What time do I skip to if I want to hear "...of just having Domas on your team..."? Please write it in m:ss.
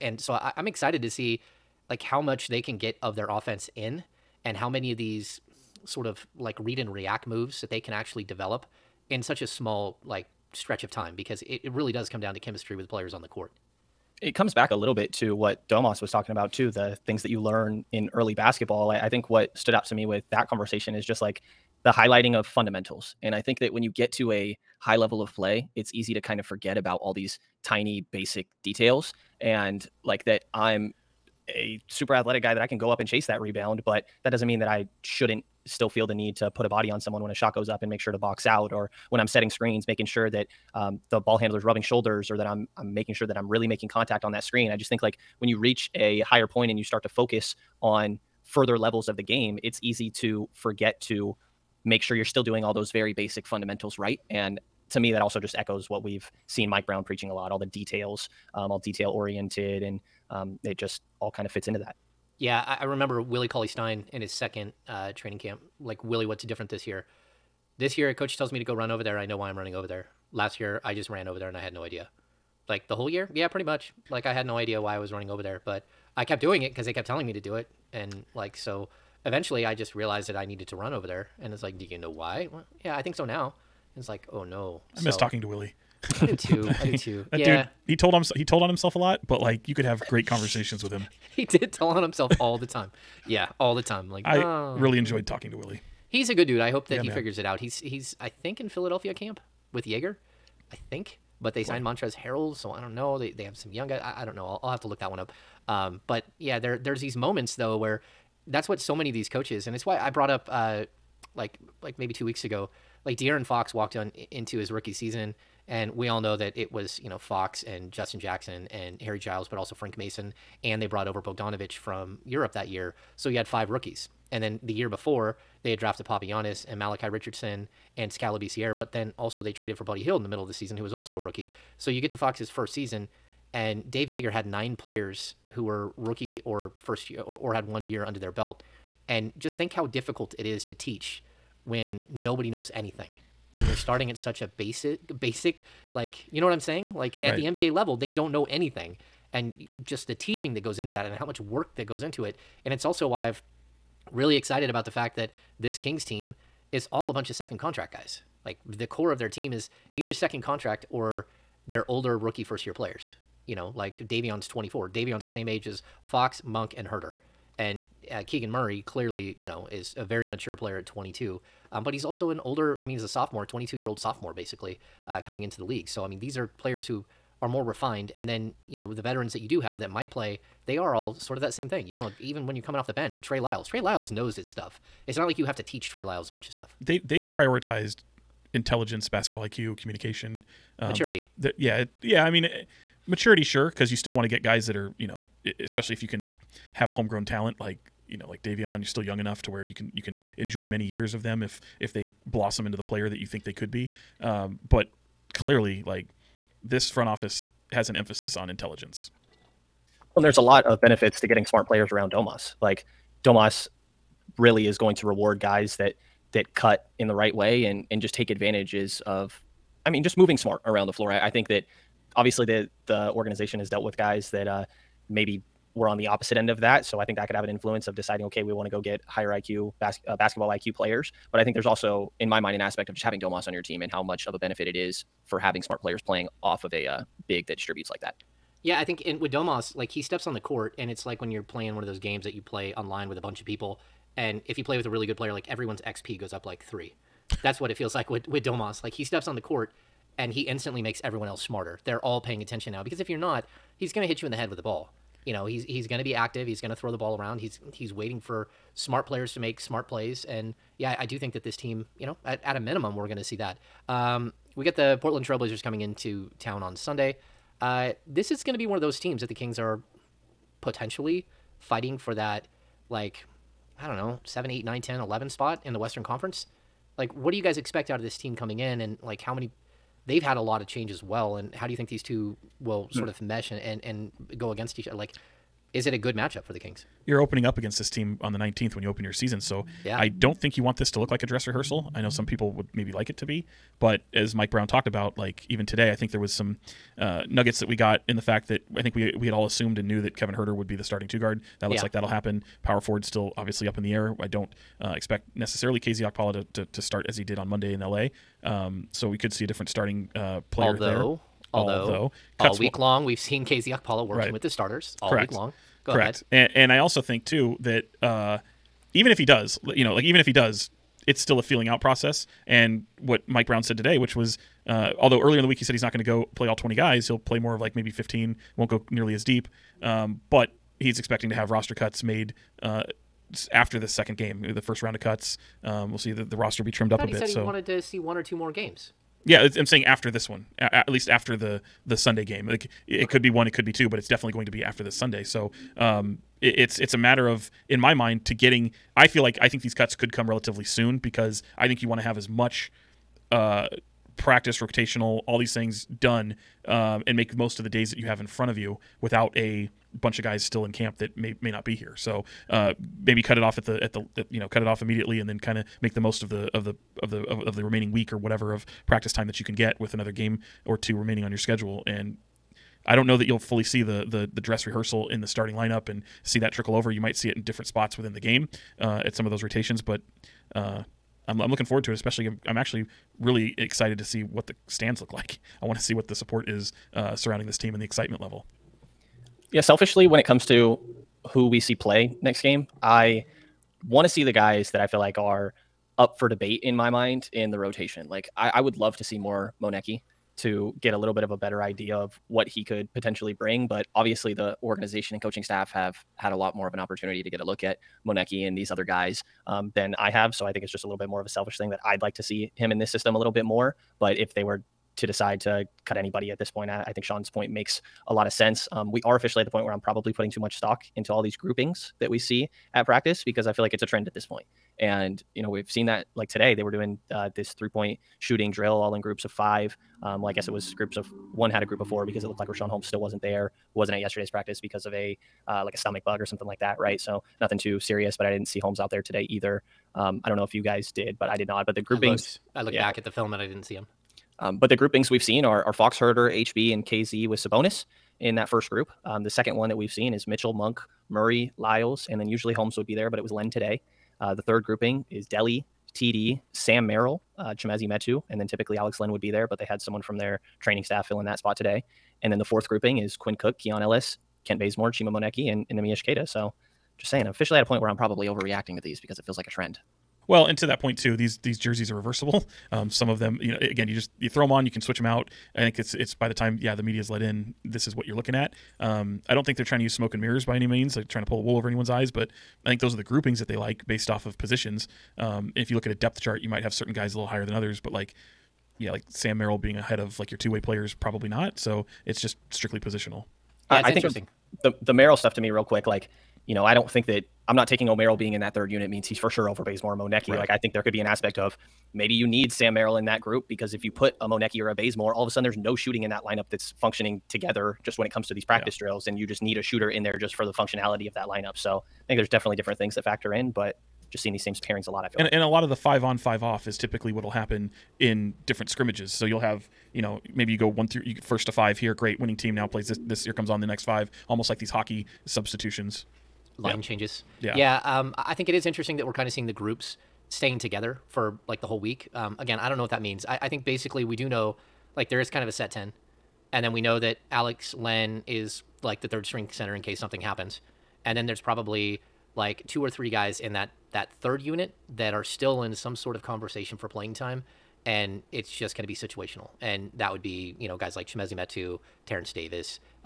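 3:52.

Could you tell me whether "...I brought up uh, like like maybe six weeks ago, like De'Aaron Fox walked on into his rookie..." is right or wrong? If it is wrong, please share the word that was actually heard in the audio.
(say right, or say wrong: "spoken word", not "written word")
wrong: "two", not "six".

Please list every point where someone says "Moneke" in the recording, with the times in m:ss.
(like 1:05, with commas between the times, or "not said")
6:39, 6:48, 7:45, 8:19, 8:24.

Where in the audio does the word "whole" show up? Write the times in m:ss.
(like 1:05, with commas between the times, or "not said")
1:12, 8:51.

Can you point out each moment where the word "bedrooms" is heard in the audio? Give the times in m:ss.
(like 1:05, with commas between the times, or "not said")
not said.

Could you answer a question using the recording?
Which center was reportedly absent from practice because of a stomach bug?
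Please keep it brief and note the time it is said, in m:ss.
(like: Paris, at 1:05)
Richaun Holmes, at 7:12.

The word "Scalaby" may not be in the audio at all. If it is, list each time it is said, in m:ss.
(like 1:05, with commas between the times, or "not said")
2:08.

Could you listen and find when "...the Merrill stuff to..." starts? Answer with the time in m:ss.
8:14.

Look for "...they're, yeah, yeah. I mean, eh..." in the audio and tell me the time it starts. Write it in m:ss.
3:11.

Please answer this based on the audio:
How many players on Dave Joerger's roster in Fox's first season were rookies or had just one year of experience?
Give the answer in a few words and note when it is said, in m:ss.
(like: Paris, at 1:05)
9, at 2:14.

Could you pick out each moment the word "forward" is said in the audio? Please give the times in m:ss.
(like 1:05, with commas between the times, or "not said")
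5:02, 6:21.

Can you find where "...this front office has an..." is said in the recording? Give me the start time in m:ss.
3:26.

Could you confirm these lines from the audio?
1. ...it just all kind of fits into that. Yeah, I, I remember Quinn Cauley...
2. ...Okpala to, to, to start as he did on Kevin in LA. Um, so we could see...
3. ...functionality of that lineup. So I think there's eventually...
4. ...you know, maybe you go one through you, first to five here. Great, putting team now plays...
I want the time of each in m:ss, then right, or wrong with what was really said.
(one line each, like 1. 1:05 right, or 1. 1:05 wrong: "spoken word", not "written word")
1. 1:00 wrong: "Willie", not "Quinn"
2. 5:06 wrong: "Monday", not "Kevin"
3. 8:30 wrong: "definitely", not "eventually"
4. 8:39 wrong: "winning", not "putting".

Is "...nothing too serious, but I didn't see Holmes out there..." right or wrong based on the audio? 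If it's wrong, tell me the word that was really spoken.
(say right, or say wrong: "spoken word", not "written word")
right.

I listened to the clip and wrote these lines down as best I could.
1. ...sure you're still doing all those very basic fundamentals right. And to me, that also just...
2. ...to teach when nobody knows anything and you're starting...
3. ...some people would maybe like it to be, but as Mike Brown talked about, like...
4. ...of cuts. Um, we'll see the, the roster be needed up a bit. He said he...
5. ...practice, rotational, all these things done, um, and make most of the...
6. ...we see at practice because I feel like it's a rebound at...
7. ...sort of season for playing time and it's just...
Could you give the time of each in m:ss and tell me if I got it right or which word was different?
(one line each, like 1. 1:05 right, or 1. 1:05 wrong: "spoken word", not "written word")
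1. 0:52 right
2. 2:20 right
3. 4:52 right
4. 5:34 wrong: "trimmed", not "needed"
5. 5:54 right
6. 7:02 wrong: "trend", not "rebound"
7. 9:05 wrong: "conversation", not "season".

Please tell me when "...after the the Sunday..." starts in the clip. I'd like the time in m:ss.
5:41.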